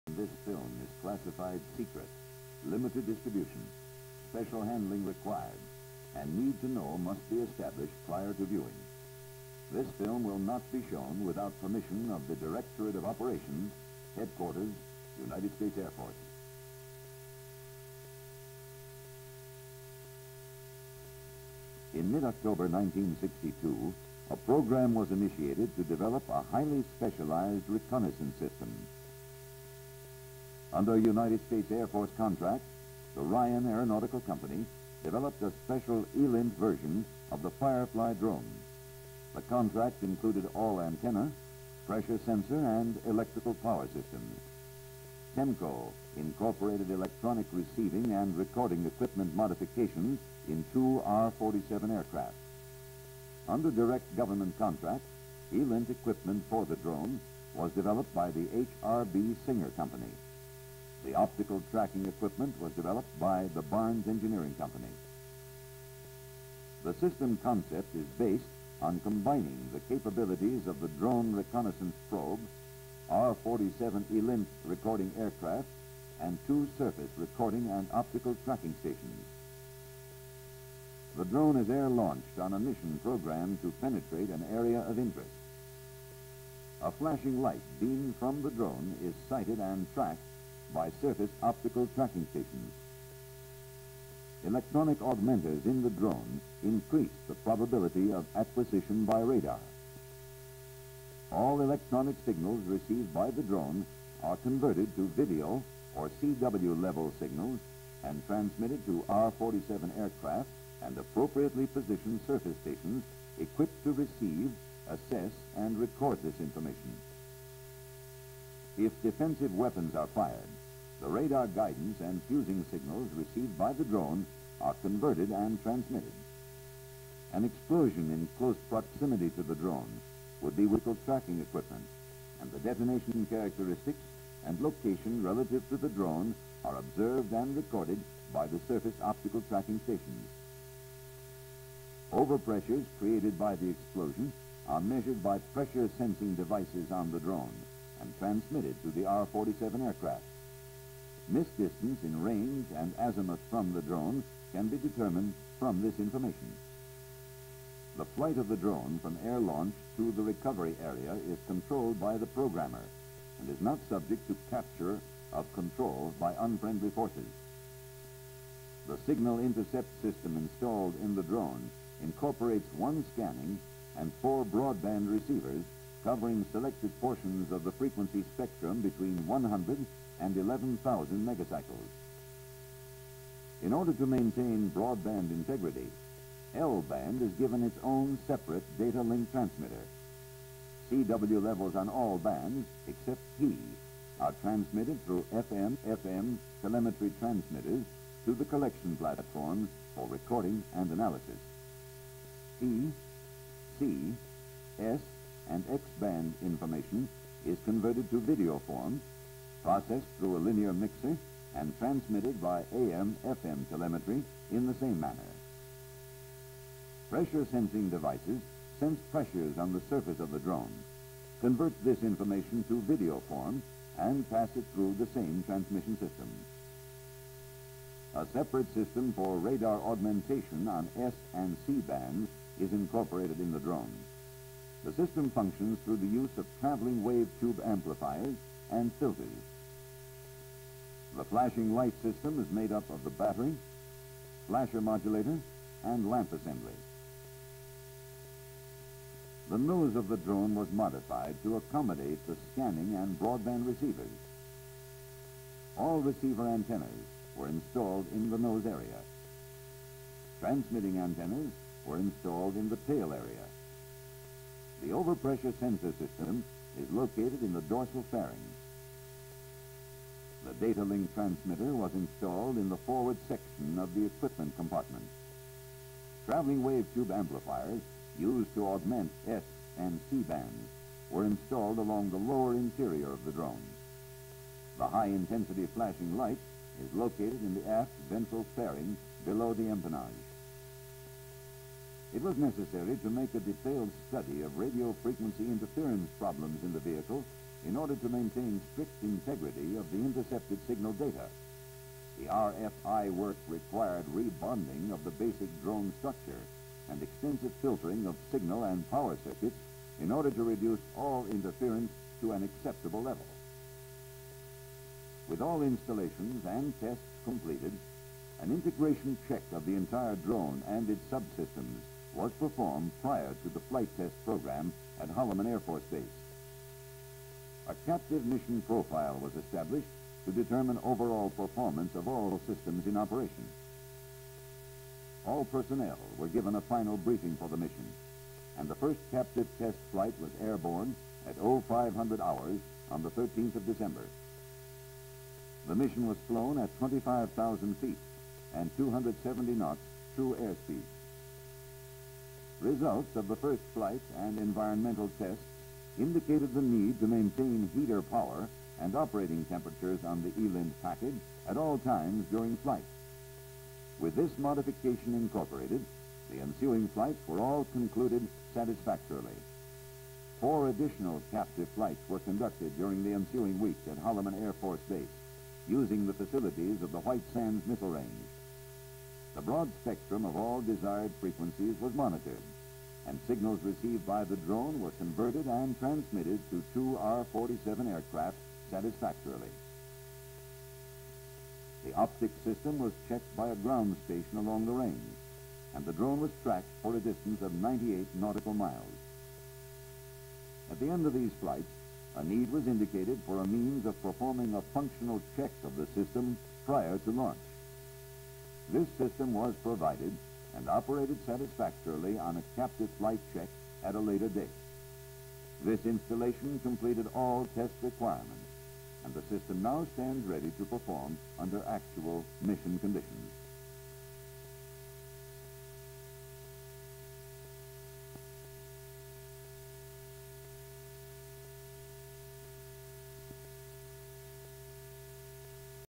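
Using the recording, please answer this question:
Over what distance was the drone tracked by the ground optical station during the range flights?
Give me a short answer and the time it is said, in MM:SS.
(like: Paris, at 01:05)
98 nautical miles, at 06:37.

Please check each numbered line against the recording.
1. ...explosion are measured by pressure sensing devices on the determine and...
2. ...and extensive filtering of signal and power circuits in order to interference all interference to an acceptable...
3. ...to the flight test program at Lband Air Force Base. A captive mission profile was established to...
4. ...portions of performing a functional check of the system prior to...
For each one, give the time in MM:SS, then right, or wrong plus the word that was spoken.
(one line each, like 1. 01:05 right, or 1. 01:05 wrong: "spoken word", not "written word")
1. 02:23 wrong: "drone", not "determine"
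2. 05:06 wrong: "reduce", not "interference"
3. 05:23 wrong: "Holloman", not "Lband"
4. 06:43 wrong: "means", not "portions".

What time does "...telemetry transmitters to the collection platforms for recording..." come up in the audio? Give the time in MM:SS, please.
03:16.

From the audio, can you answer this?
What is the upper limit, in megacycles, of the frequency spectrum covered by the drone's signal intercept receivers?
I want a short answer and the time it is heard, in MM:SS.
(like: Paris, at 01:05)
11,000, at 03:00.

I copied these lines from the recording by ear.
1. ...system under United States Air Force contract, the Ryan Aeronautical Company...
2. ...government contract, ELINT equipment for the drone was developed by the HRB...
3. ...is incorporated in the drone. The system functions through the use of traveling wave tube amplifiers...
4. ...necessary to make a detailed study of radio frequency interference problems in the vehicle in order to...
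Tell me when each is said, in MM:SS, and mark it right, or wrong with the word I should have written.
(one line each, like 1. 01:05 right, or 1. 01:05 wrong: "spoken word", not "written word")
1. 00:28 right
2. 00:54 right
3. 03:52 right
4. 04:52 right.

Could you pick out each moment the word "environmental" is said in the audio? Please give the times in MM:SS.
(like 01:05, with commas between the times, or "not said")
05:54.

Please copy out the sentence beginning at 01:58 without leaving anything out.
If defensive weapons are fired, the radar guidance and fusing signals received by the drone are converted and transmitted.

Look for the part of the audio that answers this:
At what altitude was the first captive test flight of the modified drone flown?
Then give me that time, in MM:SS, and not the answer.
05:46.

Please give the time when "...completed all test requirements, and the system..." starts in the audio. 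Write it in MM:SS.
06:56.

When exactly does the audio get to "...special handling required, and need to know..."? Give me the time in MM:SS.
00:04.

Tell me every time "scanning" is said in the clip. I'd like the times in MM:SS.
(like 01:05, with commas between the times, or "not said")
02:53, 04:12.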